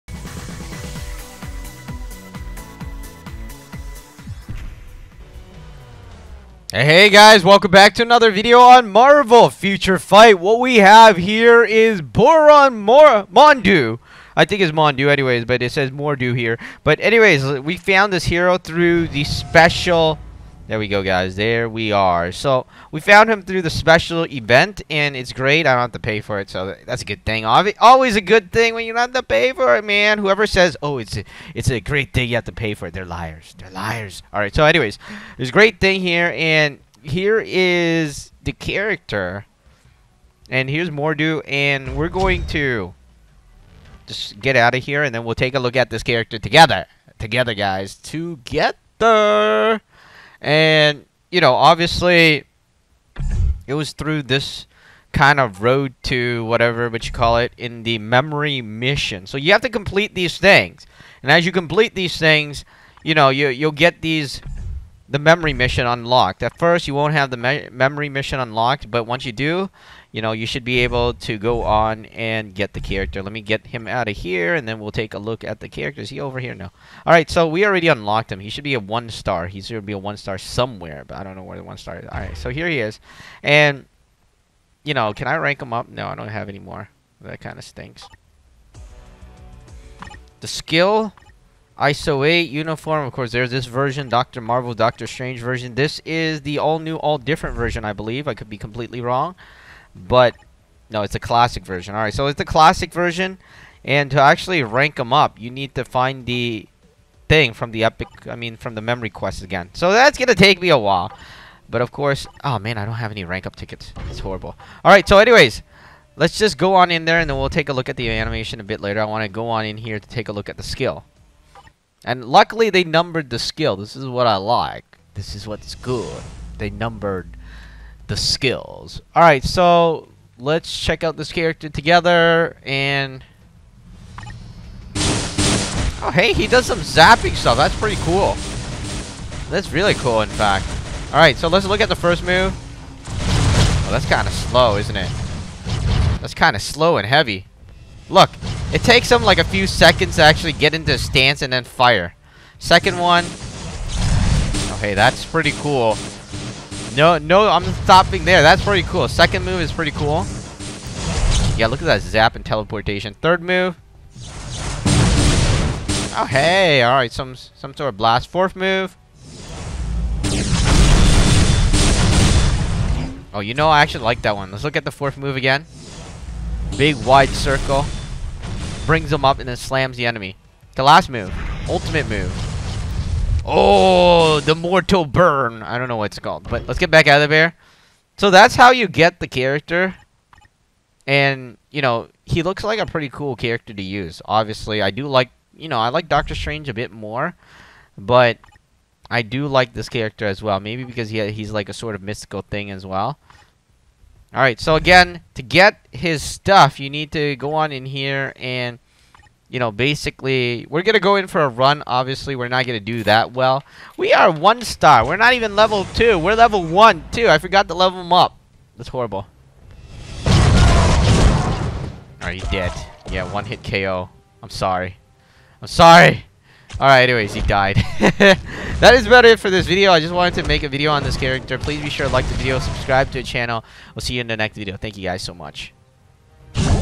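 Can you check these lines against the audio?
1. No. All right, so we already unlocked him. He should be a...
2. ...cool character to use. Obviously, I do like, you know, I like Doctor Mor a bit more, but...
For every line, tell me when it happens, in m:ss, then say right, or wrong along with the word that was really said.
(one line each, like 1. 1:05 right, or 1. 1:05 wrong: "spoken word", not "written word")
1. 1:16 right
2. 3:13 wrong: "Strange", not "Mor".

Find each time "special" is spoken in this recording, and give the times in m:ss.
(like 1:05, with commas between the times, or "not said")
0:19, 0:23.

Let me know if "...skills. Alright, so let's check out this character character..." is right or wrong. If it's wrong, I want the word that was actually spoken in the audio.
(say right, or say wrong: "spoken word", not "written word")
wrong: "together", not "character".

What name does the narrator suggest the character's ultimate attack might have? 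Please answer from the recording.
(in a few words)
Mortal burn.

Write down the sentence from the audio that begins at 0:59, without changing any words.
So you have to complete these things.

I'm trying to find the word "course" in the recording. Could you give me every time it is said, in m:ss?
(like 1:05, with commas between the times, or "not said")
1:33, 1:51.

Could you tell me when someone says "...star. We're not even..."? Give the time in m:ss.
3:34.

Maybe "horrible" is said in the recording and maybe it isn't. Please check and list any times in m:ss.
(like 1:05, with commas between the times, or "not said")
1:54, 3:38.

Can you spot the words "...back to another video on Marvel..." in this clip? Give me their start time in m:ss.
0:07.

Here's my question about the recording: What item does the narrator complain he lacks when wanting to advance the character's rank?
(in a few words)
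Rank up tickets.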